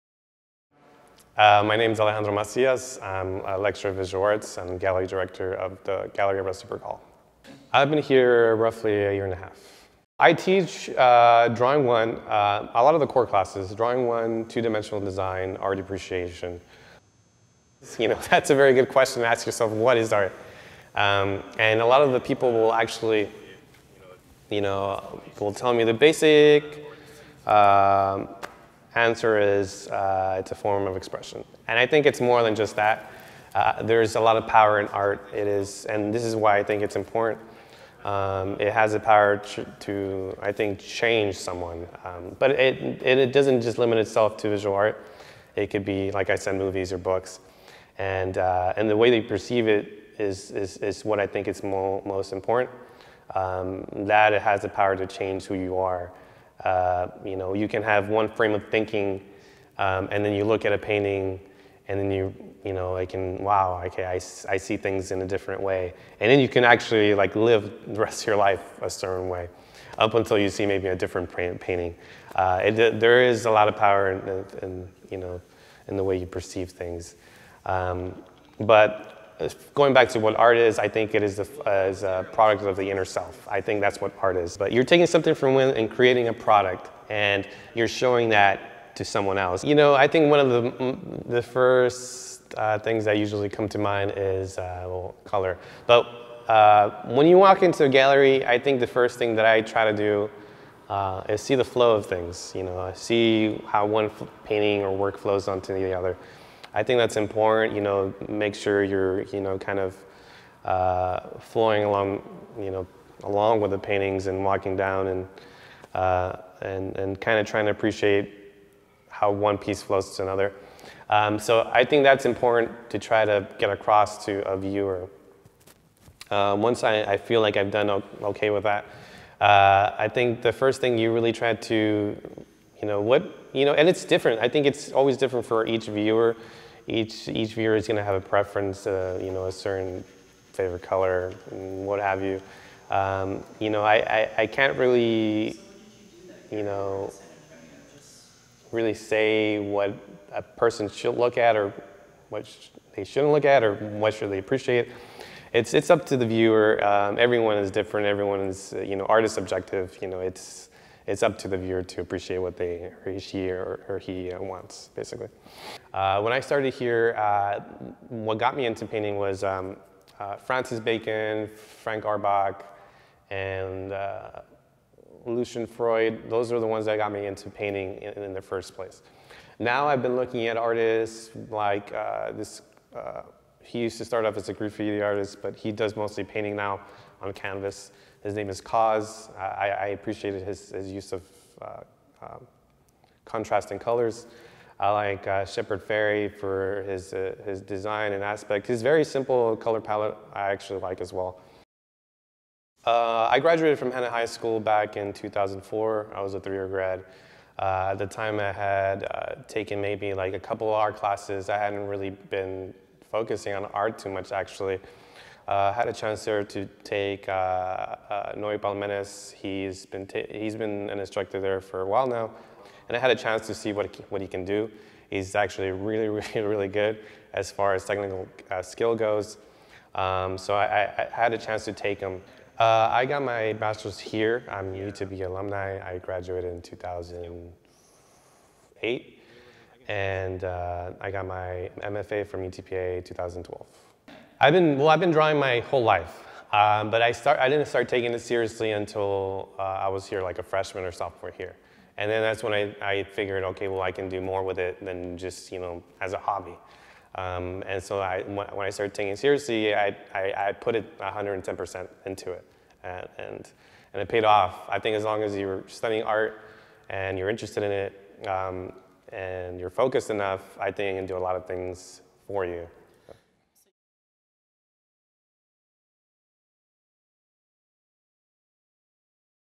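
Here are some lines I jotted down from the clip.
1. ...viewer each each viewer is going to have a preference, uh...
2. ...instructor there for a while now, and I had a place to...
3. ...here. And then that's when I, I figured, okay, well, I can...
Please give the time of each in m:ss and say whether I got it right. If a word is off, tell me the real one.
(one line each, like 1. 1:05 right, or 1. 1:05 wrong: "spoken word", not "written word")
1. 2:15 right
2. 3:41 wrong: "chance", not "place"
3. 4:11 right.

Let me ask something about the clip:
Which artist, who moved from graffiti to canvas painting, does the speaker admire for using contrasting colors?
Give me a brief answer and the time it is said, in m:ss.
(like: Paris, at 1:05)
Kaws, at 3:08.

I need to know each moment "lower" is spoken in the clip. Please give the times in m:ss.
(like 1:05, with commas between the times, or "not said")
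not said.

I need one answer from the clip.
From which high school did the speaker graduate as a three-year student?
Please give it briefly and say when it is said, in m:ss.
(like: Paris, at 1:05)
Hanna High School, at 3:23.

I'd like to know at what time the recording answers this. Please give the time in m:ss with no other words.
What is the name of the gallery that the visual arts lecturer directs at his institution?
0:06.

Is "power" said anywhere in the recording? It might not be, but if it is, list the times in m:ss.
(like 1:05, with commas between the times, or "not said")
0:34, 0:38, 0:54, 1:13.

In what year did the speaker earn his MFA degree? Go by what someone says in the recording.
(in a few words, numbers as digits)
2012.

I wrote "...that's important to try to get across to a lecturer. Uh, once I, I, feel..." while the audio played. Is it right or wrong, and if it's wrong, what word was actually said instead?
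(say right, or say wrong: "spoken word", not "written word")
wrong: "viewer", not "lecturer".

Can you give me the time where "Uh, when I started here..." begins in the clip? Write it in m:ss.
2:45.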